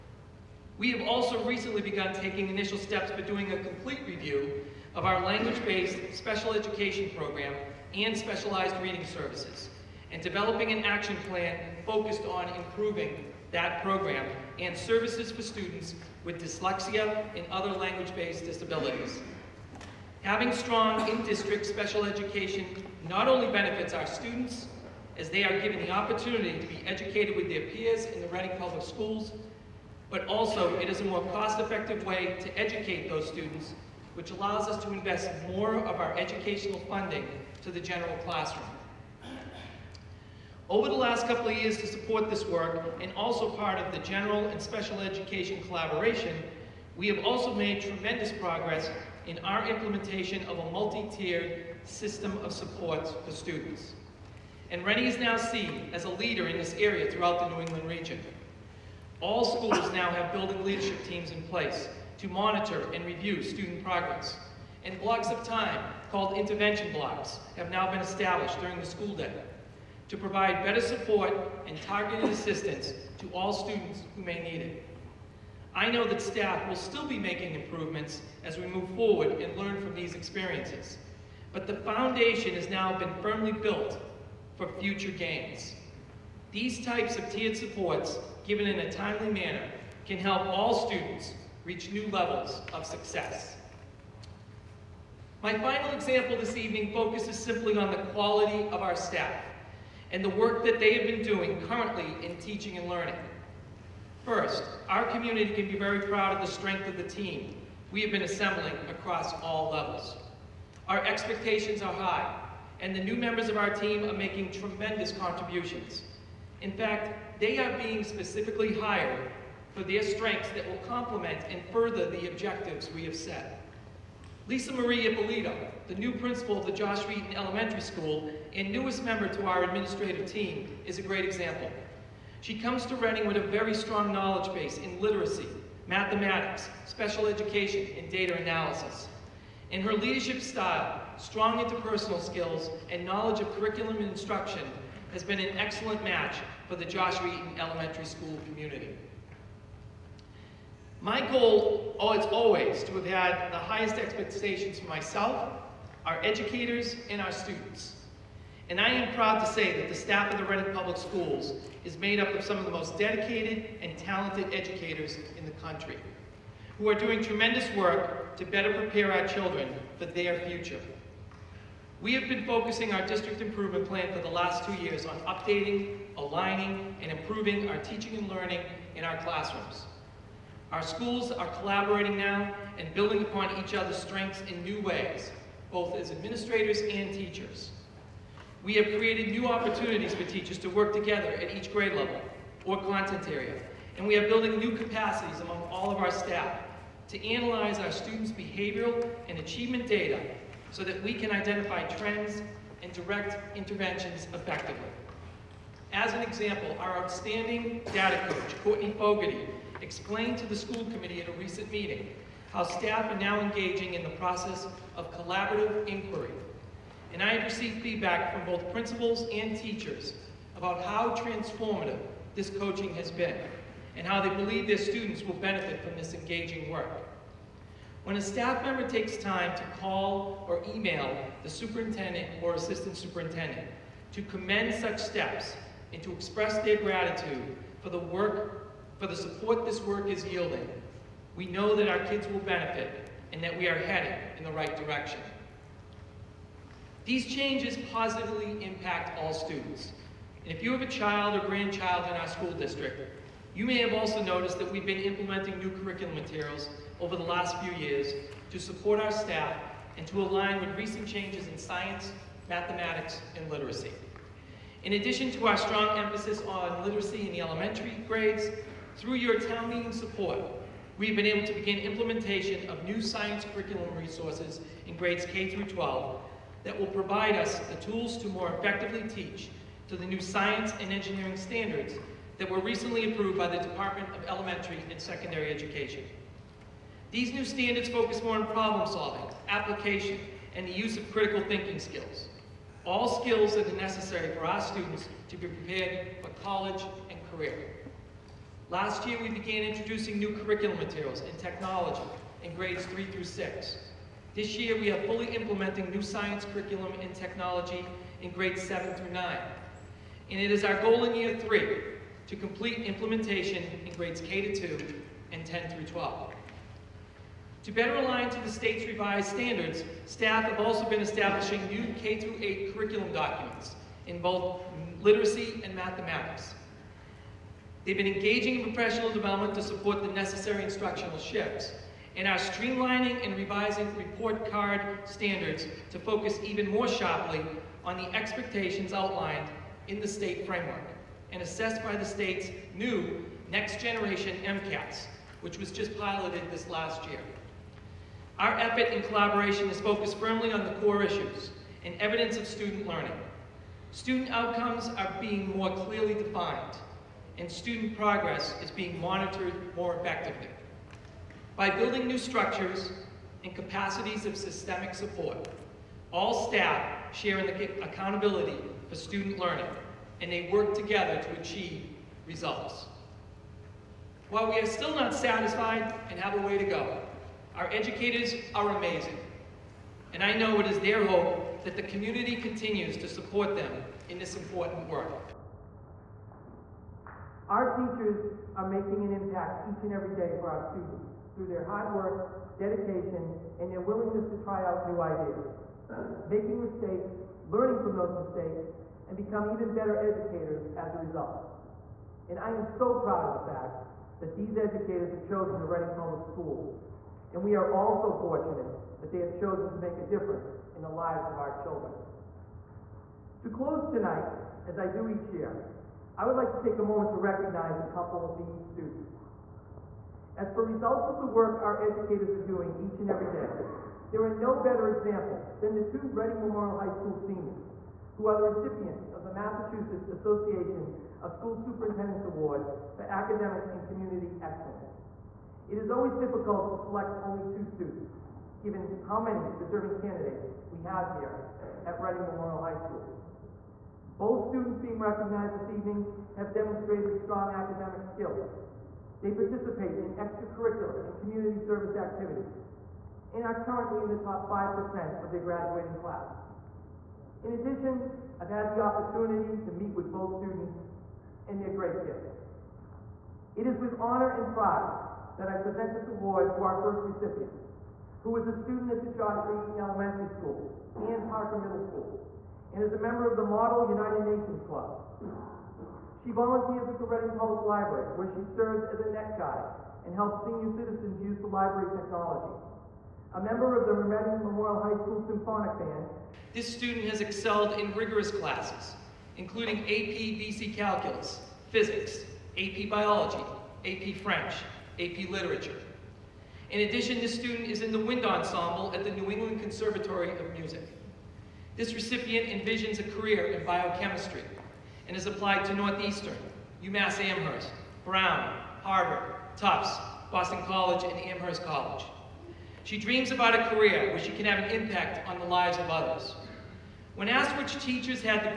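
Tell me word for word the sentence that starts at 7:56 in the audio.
She volunteers at the Reading Public Library, where she serves as a net guide and helps senior citizens use the library technology.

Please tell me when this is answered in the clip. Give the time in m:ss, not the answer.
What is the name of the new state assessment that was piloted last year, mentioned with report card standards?
5:43.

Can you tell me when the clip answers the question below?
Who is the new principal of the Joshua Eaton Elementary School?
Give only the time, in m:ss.
2:04.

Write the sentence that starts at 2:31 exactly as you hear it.
My goal is always to have had the highest expectations for myself, our educators, and our students.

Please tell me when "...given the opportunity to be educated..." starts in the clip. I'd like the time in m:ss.
0:25.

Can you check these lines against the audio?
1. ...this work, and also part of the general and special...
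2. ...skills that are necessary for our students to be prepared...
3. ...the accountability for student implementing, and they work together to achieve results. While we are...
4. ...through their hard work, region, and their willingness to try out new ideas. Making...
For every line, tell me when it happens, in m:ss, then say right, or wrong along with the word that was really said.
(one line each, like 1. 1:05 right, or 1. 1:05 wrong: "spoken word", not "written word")
1. 0:42 right
2. 4:53 right
3. 6:07 wrong: "learning", not "implementing"
4. 6:31 wrong: "dedication", not "region".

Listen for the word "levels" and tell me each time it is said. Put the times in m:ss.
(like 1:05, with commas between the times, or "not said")
1:32, 1:49, 3:11.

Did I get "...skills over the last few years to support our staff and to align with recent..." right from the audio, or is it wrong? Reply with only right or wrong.
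wrong.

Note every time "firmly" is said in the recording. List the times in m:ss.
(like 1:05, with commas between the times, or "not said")
1:23, 5:50.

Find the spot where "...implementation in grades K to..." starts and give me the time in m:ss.
5:12.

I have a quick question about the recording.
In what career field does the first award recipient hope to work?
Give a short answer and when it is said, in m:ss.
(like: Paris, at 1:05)
biochemistry, at 8:23.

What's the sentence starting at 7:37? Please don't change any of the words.
In addition, I've had the opportunity to meet with both students and their great kids.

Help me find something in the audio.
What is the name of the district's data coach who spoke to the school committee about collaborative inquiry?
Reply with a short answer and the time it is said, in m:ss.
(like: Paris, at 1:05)
Courtney Fogarty, at 3:28.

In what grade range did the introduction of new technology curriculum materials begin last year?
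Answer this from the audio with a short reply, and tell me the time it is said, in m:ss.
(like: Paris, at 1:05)
grades 3 through 6, at 5:02.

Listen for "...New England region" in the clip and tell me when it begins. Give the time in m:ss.
0:57.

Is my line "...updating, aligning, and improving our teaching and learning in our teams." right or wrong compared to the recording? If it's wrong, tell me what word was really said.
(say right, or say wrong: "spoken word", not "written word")
wrong: "classrooms", not "teams".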